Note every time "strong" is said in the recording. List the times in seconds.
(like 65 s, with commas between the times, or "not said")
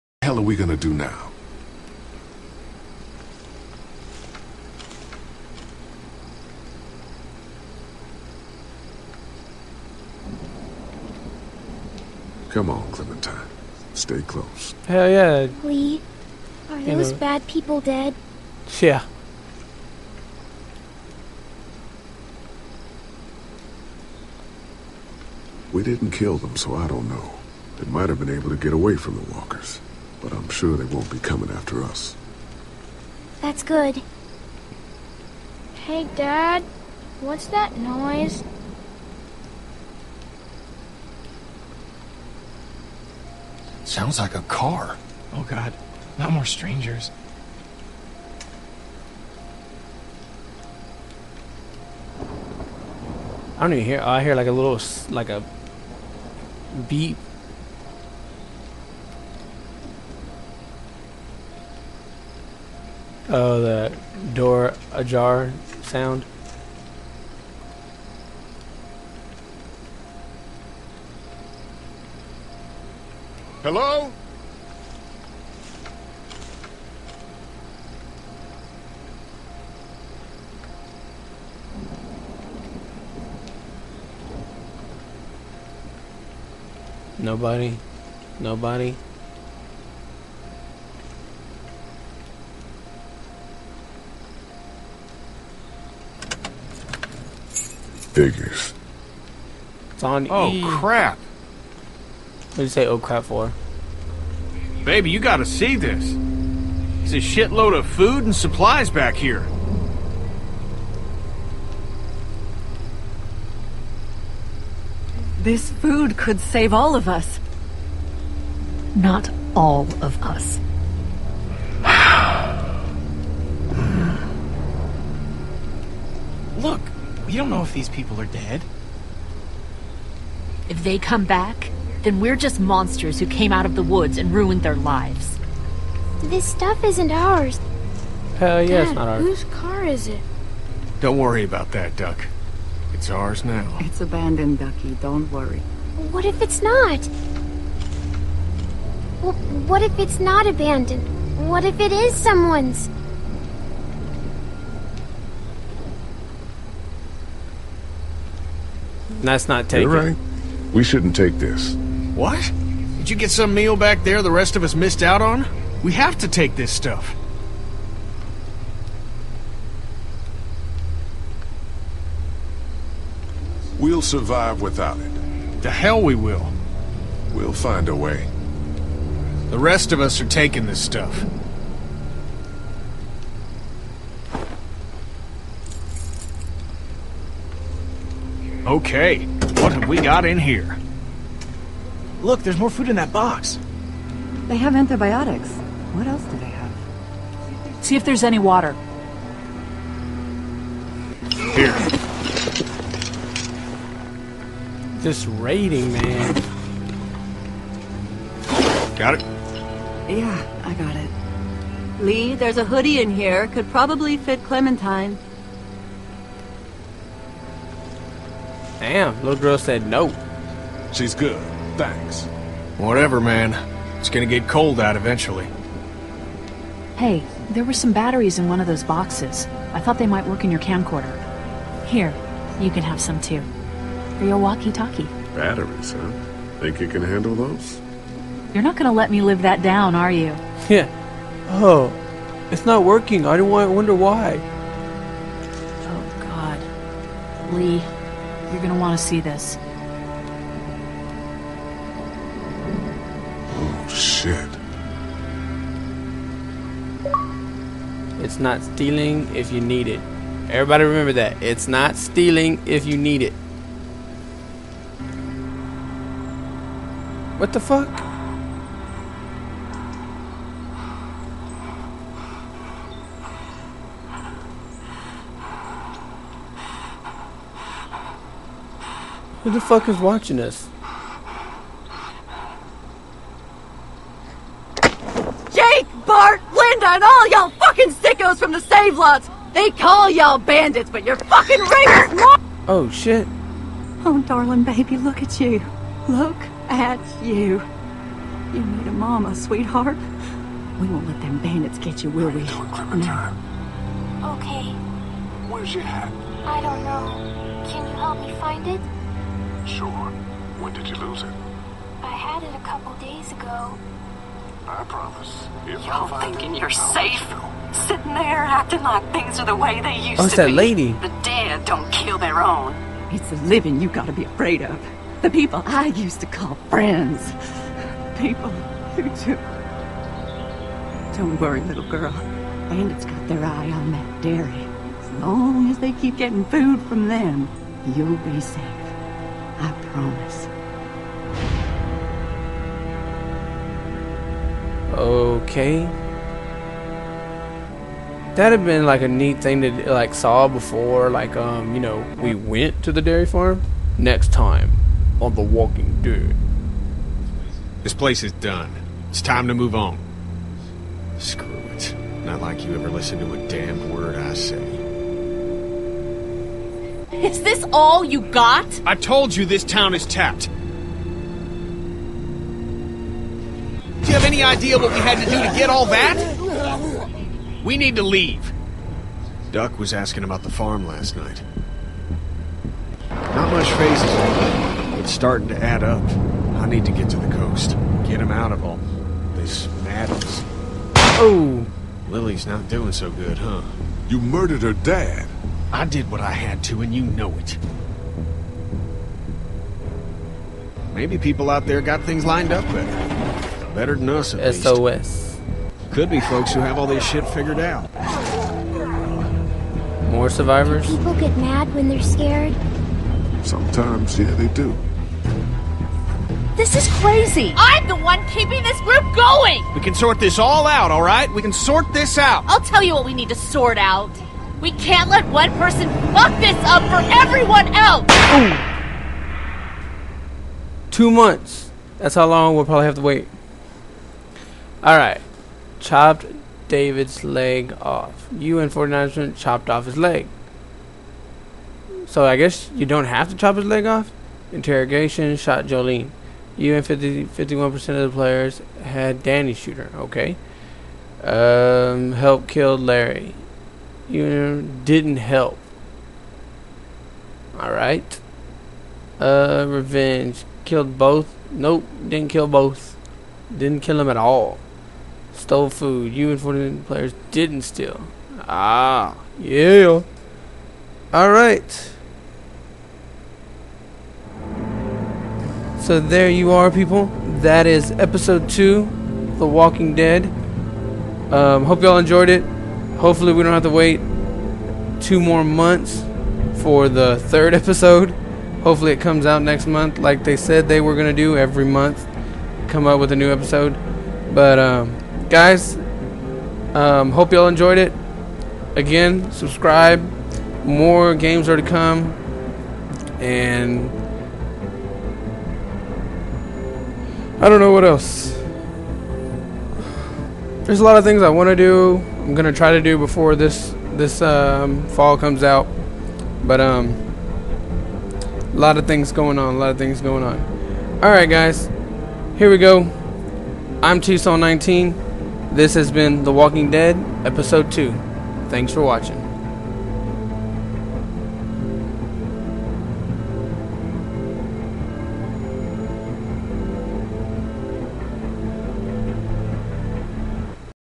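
not said.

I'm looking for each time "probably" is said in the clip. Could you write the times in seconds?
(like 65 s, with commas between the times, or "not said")
213 s, 432 s.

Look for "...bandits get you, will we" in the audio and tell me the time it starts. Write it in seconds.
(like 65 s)
301 s.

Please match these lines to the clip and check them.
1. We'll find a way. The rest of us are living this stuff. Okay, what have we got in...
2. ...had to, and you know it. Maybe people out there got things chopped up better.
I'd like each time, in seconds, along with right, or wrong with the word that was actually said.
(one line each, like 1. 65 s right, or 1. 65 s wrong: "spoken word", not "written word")
1. 177 s wrong: "taking", not "living"
2. 396 s wrong: "lined", not "chopped".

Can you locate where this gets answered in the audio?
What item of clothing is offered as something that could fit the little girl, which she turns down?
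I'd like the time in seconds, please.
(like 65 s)
212 s.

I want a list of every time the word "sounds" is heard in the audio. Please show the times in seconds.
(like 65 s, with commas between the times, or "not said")
43 s, 65 s.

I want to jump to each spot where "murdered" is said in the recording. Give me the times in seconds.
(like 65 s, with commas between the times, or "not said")
394 s.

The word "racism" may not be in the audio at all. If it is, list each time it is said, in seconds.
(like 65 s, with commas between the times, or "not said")
not said.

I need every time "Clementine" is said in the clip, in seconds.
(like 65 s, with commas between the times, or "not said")
12 s, 214 s.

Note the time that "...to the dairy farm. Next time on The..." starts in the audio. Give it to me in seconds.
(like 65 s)
352 s.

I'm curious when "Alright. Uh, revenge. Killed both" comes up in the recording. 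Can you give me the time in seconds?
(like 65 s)
457 s.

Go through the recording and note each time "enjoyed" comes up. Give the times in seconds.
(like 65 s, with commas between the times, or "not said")
481 s, 497 s.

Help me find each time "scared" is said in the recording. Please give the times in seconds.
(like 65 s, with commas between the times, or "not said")
412 s.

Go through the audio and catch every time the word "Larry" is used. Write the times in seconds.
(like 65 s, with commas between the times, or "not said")
452 s.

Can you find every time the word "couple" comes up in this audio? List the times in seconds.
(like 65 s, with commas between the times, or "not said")
312 s.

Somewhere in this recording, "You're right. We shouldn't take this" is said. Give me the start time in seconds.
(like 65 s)
159 s.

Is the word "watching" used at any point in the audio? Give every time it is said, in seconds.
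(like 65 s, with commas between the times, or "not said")
279 s, 528 s.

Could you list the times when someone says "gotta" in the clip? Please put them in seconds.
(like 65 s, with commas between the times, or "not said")
105 s, 323 s.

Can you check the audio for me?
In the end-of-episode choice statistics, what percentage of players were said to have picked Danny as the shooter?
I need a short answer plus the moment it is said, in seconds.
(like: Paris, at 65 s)
51%, at 446 s.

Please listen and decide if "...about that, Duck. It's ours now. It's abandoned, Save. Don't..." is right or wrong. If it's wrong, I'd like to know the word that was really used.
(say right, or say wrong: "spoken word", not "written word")
wrong: "Ducky", not "Save".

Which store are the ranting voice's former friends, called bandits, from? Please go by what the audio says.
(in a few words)
Save Lots.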